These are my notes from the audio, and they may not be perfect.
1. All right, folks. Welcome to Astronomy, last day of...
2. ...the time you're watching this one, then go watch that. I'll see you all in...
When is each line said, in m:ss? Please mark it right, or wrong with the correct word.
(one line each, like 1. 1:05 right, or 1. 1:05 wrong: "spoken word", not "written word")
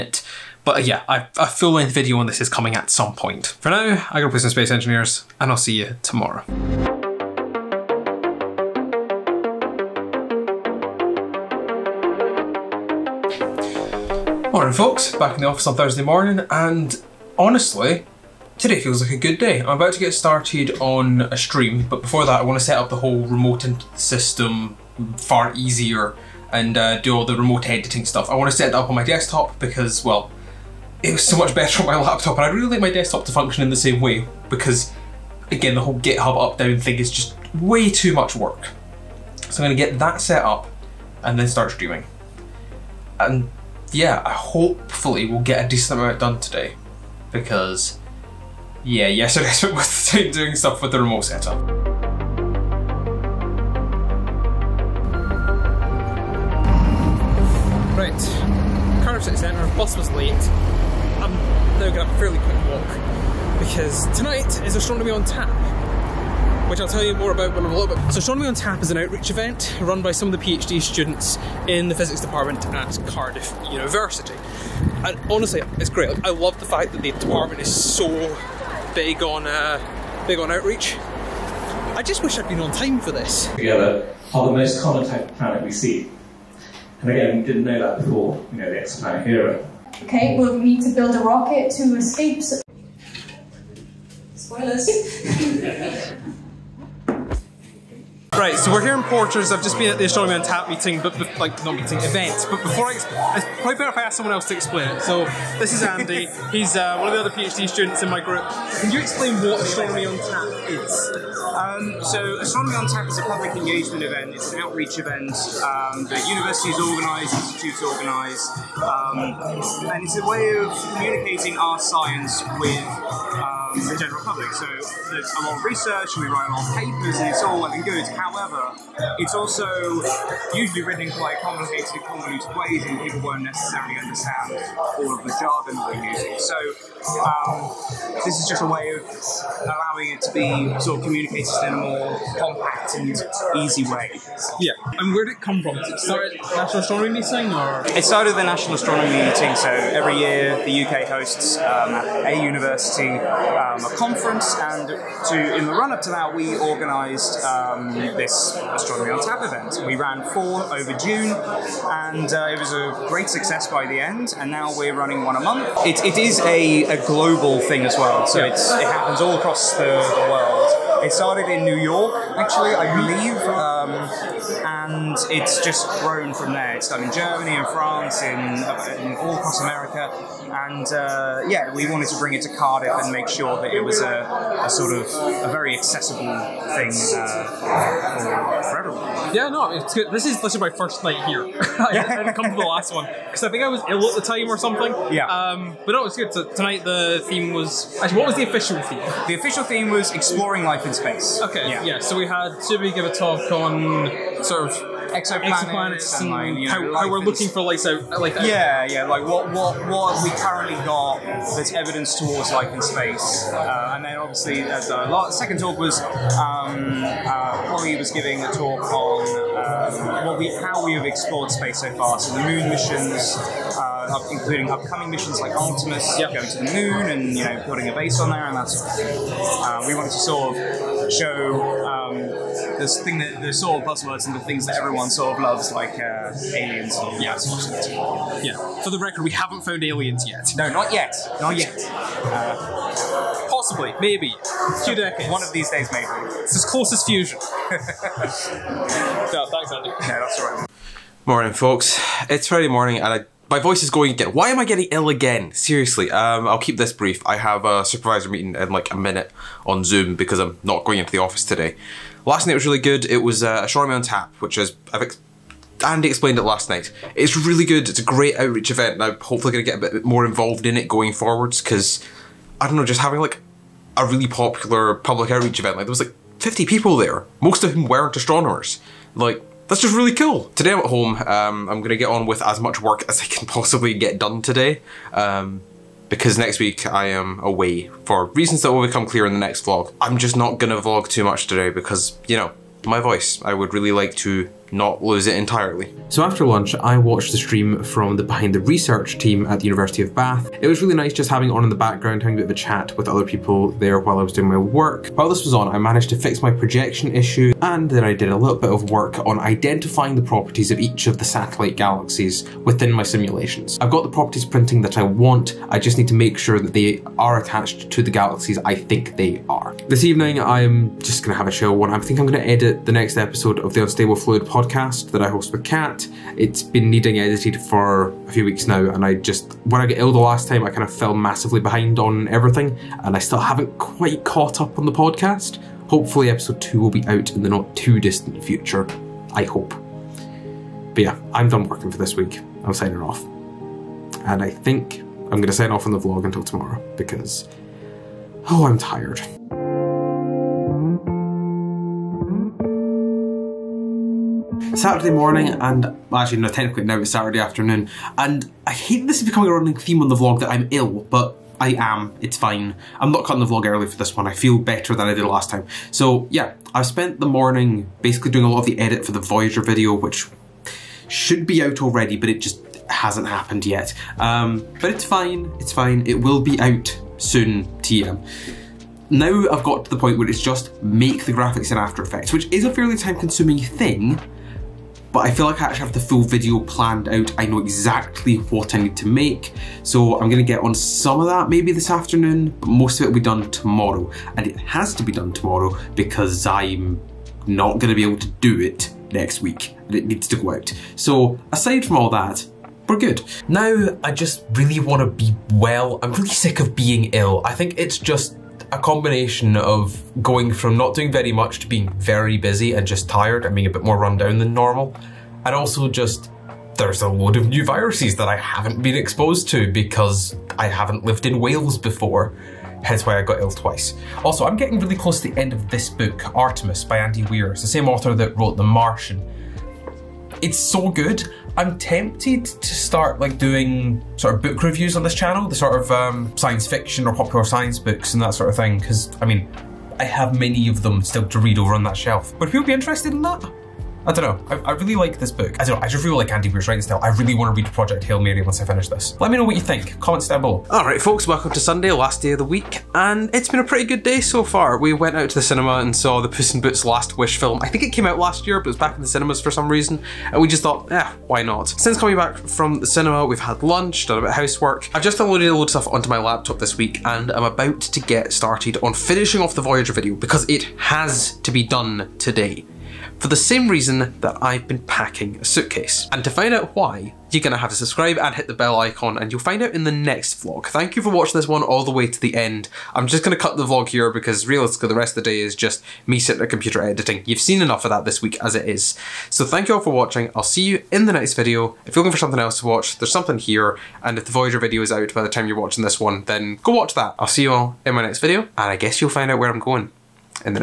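1. 7:30 wrong: "Sunday", not "Astronomy"
2. 8:15 right.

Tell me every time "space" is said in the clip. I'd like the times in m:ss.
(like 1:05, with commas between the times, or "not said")
0:04, 3:20, 3:32, 3:41.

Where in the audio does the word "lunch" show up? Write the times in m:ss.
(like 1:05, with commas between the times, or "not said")
4:56, 7:43.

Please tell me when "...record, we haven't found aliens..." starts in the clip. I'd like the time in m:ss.
3:58.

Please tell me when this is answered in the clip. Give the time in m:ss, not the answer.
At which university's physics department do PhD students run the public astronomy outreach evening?
1:13.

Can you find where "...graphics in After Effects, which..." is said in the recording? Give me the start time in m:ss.
6:21.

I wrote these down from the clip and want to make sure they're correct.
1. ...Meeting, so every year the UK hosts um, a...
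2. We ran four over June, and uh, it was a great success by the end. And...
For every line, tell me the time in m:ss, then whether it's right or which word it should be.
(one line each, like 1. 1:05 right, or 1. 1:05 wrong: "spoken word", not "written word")
1. 2:29 right
2. 2:39 right.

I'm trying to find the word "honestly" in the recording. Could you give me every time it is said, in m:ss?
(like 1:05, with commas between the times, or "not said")
0:17, 1:15.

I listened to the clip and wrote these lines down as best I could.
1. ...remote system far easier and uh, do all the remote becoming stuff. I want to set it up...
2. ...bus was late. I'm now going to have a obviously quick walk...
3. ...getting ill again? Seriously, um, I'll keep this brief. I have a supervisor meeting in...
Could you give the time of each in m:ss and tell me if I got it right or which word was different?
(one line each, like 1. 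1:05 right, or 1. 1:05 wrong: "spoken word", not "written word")
1. 0:23 wrong: "editing", not "becoming"
2. 0:59 wrong: "fairly", not "obviously"
3. 4:14 right.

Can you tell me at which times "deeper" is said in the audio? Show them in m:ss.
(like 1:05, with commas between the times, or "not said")
not said.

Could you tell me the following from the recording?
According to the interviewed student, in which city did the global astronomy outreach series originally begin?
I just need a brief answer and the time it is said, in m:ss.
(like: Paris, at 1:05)
New York, at 2:51.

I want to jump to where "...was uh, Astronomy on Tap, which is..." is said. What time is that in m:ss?
4:23.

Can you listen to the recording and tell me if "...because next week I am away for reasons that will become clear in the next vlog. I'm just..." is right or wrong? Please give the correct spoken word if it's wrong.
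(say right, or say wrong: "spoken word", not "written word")
right.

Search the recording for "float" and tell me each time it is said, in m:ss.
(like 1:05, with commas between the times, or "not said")
not said.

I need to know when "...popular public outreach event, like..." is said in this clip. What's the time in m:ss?
4:34.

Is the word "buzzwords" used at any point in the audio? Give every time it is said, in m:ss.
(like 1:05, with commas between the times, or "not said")
3:53.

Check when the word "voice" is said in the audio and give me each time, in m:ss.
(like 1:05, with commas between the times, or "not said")
4:13, 4:52.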